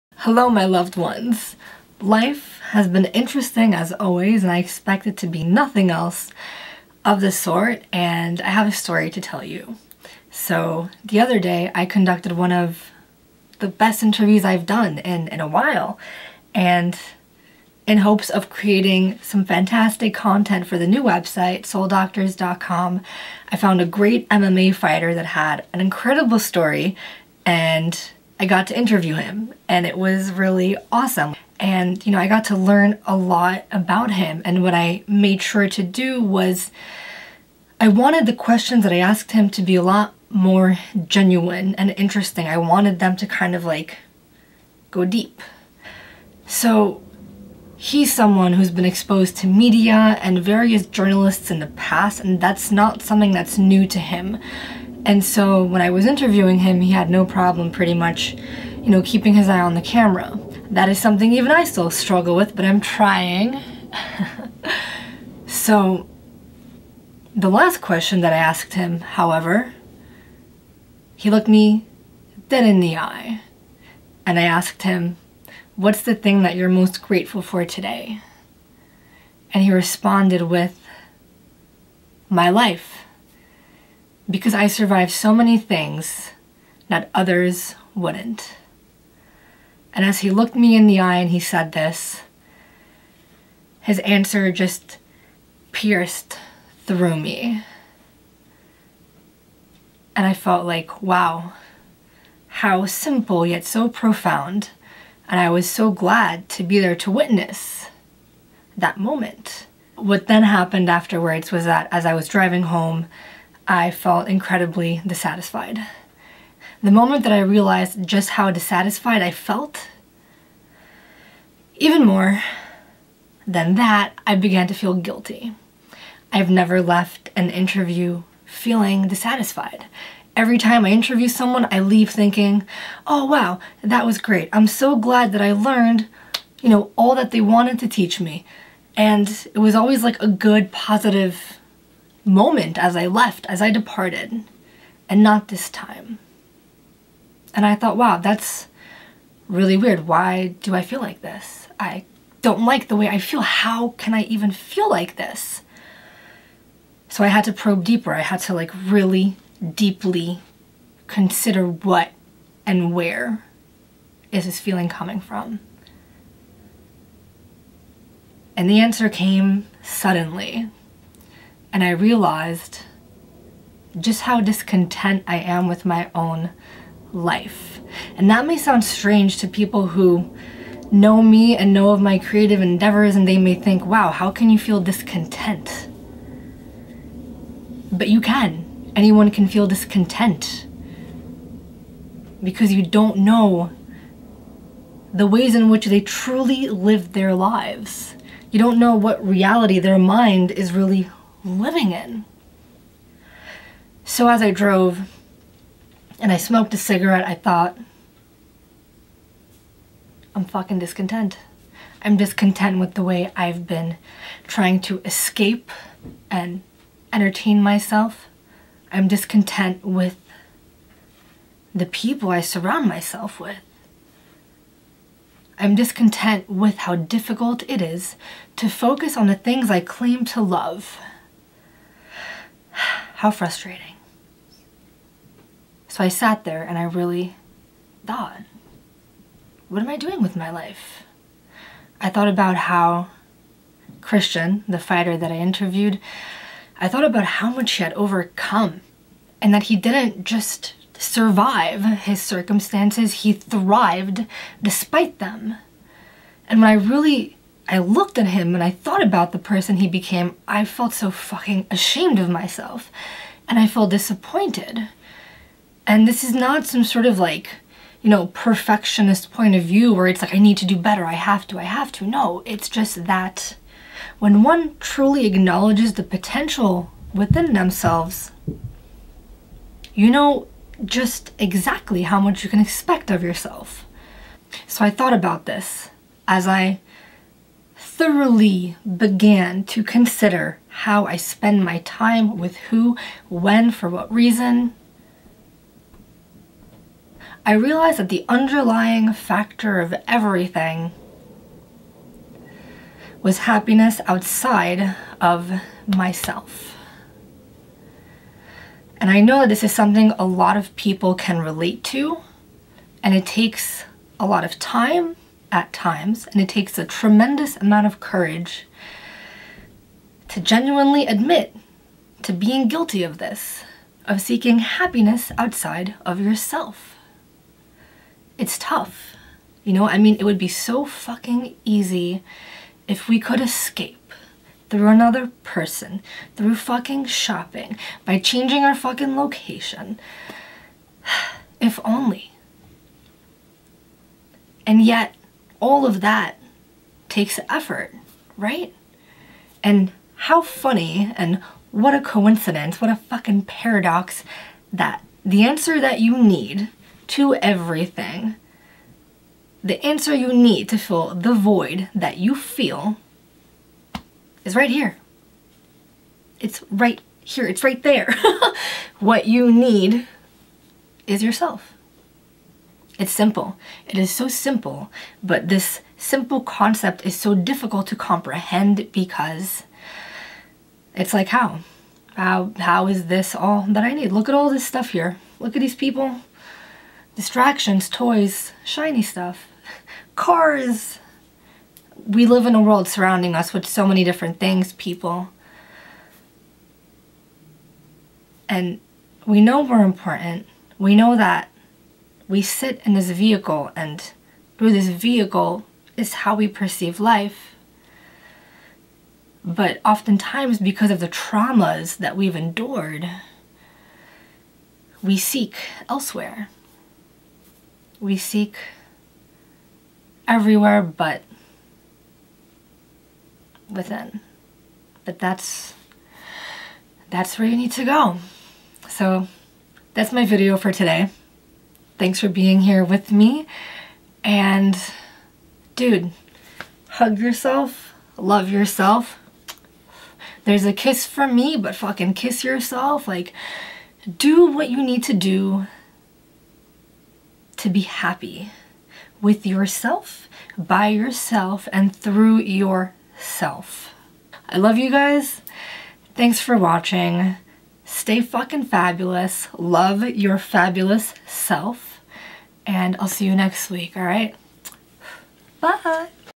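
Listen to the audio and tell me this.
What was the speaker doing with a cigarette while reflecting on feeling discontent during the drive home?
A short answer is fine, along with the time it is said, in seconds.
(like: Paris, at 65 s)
smoked a cigarette, at 206 s.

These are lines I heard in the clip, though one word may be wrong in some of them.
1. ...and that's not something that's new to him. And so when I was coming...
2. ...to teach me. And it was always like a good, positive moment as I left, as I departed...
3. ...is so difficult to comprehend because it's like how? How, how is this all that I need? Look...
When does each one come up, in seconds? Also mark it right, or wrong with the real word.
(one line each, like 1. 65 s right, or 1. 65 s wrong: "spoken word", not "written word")
1. 52 s wrong: "interviewing", not "coming"
2. 137 s right
3. 377 s right.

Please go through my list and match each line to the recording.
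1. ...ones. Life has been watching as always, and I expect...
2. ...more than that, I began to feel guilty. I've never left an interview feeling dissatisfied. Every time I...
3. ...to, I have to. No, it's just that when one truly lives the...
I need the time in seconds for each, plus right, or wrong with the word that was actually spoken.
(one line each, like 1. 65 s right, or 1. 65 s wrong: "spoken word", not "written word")
1. 0 s wrong: "interesting", not "watching"
2. 122 s right
3. 271 s wrong: "acknowledges", not "lives".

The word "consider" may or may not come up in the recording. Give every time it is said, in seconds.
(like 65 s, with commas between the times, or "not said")
161 s, 289 s.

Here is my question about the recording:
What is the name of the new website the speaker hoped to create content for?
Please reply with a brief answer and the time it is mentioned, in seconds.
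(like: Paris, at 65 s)
souldoctors.com, at 21 s.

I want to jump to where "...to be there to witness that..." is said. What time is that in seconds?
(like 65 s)
106 s.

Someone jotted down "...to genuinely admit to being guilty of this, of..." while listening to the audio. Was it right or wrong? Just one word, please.
right.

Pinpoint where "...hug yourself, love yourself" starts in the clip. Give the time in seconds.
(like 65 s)
436 s.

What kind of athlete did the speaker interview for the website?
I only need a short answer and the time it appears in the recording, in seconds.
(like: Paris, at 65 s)
MMA fighter, at 24 s.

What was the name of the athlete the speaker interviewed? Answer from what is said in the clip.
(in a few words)
Christian.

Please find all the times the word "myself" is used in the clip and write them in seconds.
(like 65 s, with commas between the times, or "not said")
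217 s, 222 s, 262 s, 305 s.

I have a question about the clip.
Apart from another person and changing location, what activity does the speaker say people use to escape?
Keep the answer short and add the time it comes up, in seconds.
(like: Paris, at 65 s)
shopping, at 337 s.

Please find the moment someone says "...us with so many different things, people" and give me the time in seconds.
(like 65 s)
393 s.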